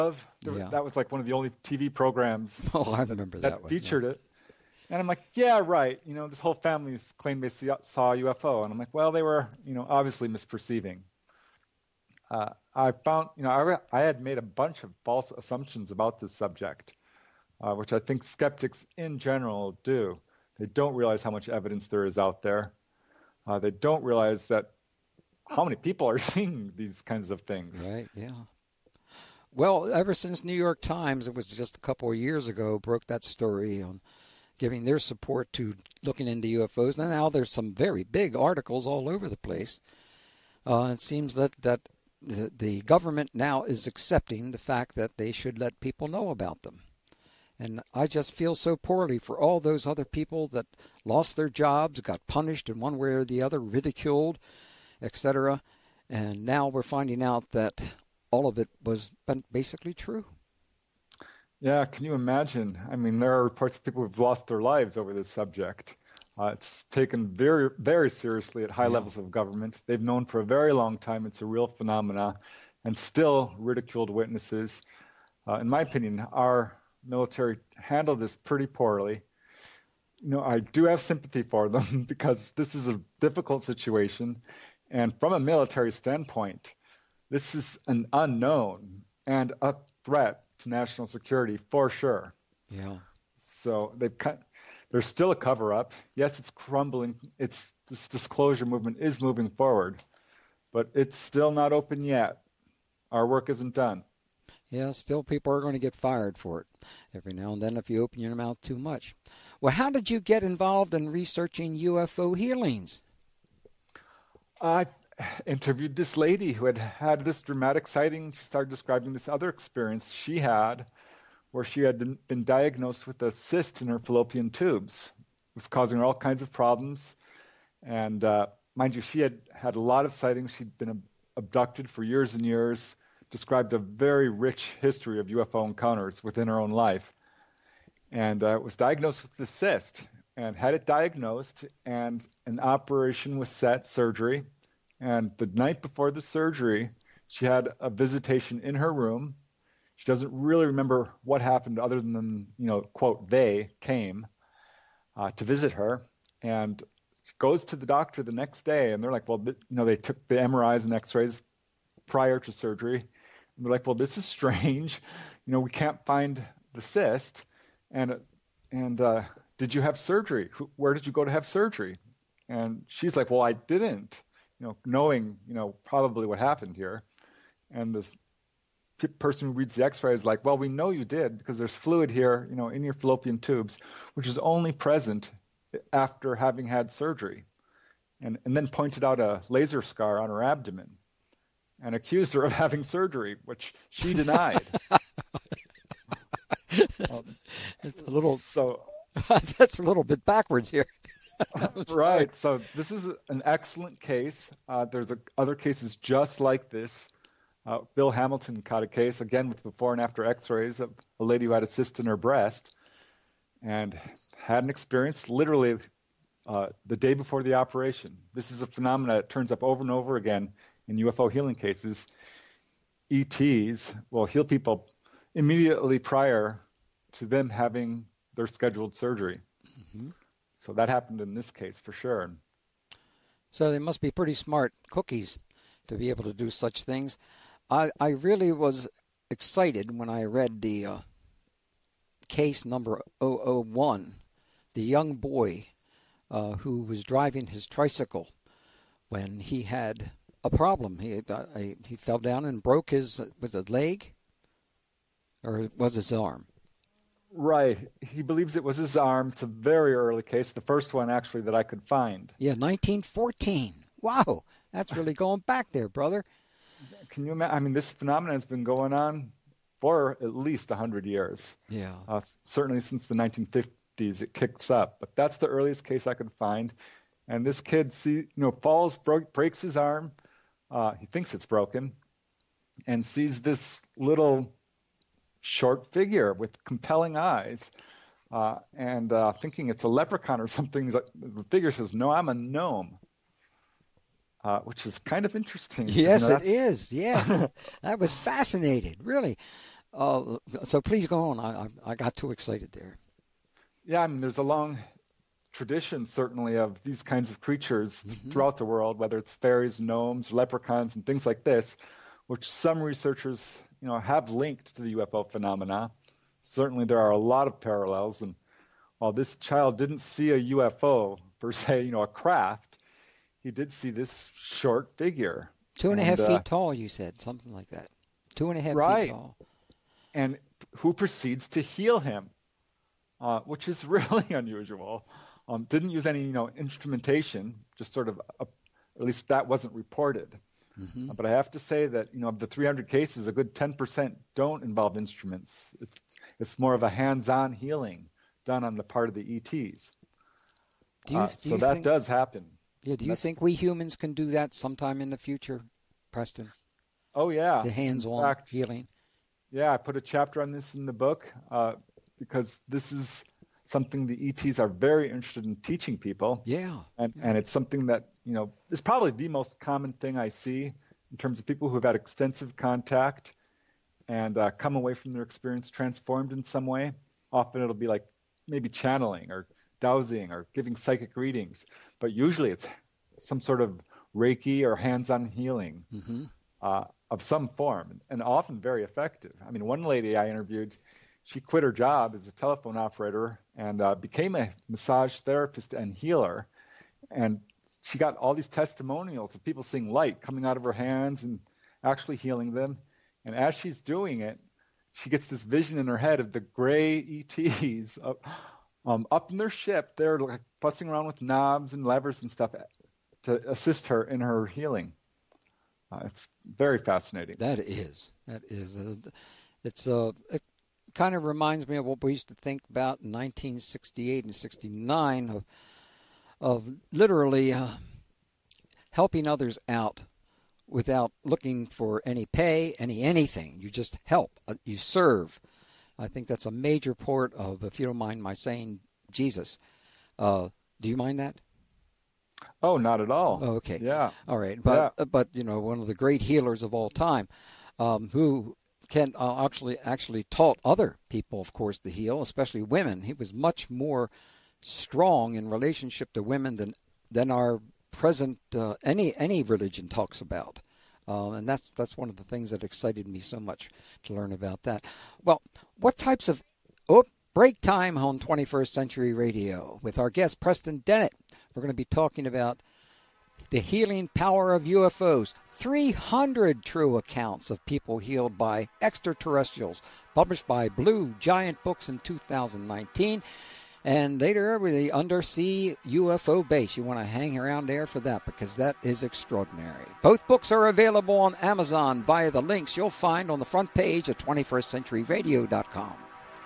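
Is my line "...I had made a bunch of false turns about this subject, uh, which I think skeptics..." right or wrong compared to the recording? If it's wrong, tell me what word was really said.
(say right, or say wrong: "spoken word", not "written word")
wrong: "assumptions", not "turns".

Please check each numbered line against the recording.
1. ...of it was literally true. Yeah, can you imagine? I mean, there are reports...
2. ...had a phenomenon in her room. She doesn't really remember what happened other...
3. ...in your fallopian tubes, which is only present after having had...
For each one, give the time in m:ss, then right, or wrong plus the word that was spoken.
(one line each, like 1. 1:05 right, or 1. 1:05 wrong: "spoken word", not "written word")
1. 0:58 wrong: "basically", not "literally"
2. 2:27 wrong: "visitation", not "phenomenon"
3. 3:02 right.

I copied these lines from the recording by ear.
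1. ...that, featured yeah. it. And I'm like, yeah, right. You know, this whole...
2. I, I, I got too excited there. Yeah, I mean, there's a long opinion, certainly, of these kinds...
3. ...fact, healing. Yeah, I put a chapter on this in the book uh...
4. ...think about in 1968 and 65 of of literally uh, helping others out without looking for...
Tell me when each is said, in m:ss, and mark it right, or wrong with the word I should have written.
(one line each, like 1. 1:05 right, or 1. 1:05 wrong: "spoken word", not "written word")
1. 0:03 right
2. 5:01 wrong: "tradition", not "opinion"
3. 5:58 right
4. 7:02 wrong: "69", not "65".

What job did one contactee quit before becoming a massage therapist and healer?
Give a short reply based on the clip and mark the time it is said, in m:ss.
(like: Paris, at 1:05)
Telephone operator, at 6:32.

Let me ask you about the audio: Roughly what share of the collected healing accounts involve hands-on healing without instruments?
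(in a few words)
10%.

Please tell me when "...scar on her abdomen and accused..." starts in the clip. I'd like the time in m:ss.
3:09.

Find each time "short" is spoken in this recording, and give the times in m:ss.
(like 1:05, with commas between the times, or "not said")
4:45, 5:24.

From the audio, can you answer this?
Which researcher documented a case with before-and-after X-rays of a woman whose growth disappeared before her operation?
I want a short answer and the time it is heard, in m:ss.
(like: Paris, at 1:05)
Bill Hamilton, at 3:27.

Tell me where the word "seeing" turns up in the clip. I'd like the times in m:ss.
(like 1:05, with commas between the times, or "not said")
0:26, 6:39.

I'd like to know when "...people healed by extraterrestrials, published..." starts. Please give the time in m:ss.
7:57.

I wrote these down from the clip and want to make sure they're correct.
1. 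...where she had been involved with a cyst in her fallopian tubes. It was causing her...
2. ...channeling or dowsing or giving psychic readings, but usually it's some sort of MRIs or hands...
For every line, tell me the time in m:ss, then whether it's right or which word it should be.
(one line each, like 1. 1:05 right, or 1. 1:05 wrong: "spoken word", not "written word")
1. 2:01 wrong: "diagnosed", not "involved"
2. 6:18 wrong: "Reiki", not "MRIs".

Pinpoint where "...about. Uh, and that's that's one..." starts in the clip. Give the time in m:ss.
7:40.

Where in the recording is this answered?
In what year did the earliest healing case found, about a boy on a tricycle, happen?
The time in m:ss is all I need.
4:22.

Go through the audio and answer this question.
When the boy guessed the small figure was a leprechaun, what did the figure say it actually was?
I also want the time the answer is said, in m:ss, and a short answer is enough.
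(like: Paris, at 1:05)
A gnome, at 4:52.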